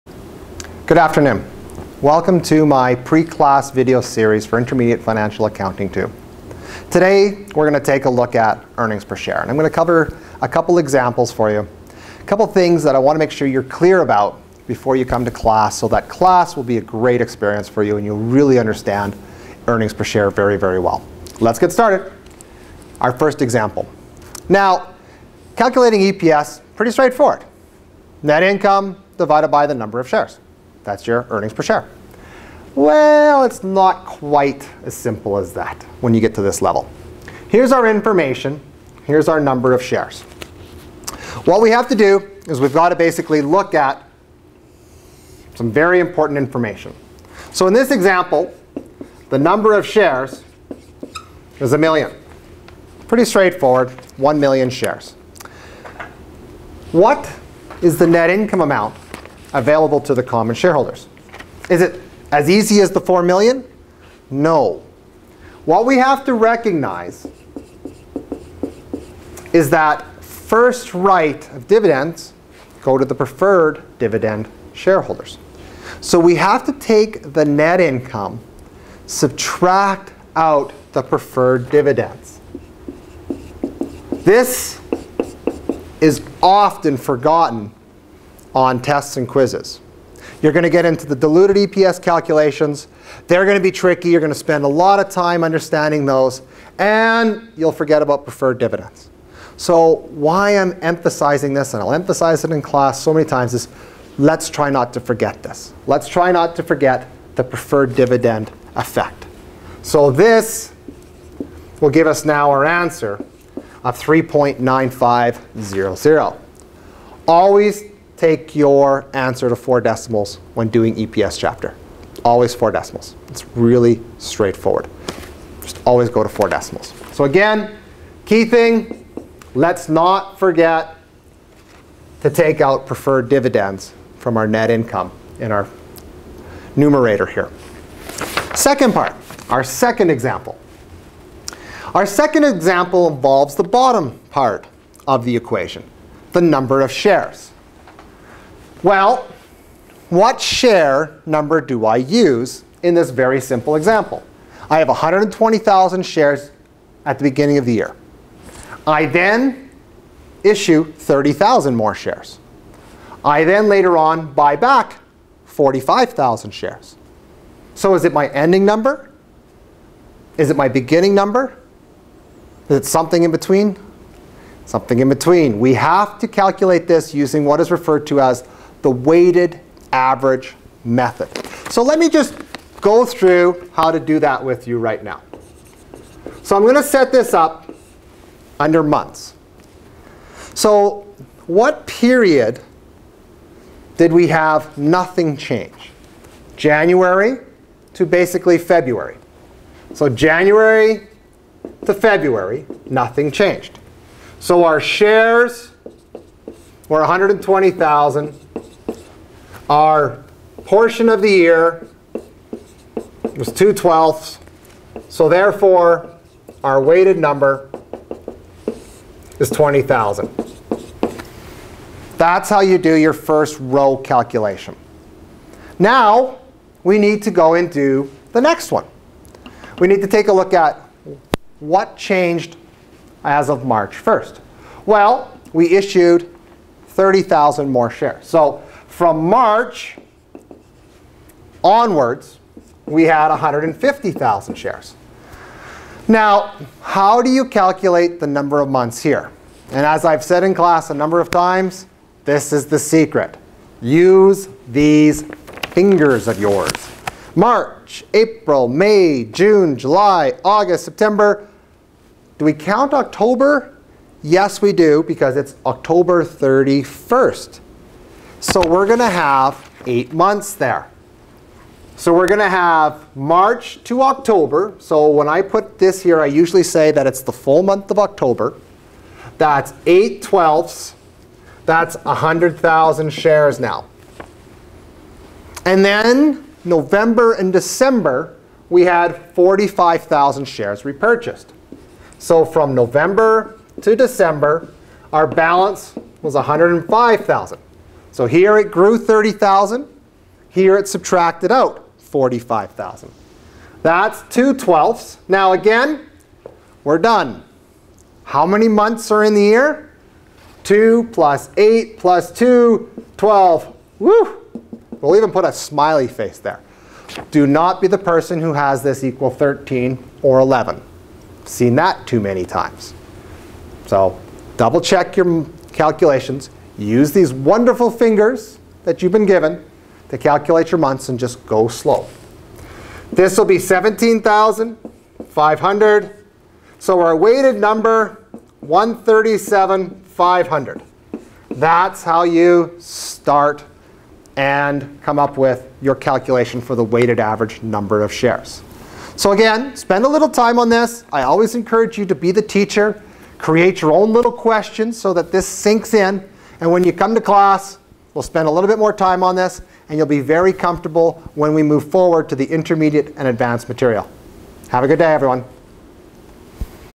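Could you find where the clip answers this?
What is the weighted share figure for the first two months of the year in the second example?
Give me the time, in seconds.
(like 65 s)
219 s.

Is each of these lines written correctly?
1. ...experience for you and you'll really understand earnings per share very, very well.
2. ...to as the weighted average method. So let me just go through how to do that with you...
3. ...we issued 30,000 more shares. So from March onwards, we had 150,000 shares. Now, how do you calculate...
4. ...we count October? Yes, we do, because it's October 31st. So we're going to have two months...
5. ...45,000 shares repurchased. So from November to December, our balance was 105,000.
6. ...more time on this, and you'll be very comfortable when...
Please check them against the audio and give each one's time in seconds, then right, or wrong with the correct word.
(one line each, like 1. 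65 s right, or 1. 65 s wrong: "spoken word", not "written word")
1. 17 s right
2. 178 s right
3. 235 s right
4. 262 s wrong: "eight", not "two"
5. 289 s right
6. 358 s right.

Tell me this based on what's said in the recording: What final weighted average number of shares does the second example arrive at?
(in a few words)
137,500.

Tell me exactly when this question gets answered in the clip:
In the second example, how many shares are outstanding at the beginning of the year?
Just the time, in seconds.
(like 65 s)
154 s.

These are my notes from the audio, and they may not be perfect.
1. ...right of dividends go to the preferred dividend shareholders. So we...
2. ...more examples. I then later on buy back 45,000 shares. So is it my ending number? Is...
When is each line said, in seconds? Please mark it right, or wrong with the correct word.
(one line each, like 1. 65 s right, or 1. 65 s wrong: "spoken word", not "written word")
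1. 70 s right
2. 161 s wrong: "shares", not "examples".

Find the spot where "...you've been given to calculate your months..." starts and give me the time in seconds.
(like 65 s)
329 s.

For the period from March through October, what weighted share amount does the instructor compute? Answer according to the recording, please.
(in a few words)
100,000.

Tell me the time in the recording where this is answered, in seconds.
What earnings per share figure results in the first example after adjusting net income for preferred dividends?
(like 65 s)
113 s.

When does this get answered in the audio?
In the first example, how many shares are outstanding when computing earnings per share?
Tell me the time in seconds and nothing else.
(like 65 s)
54 s.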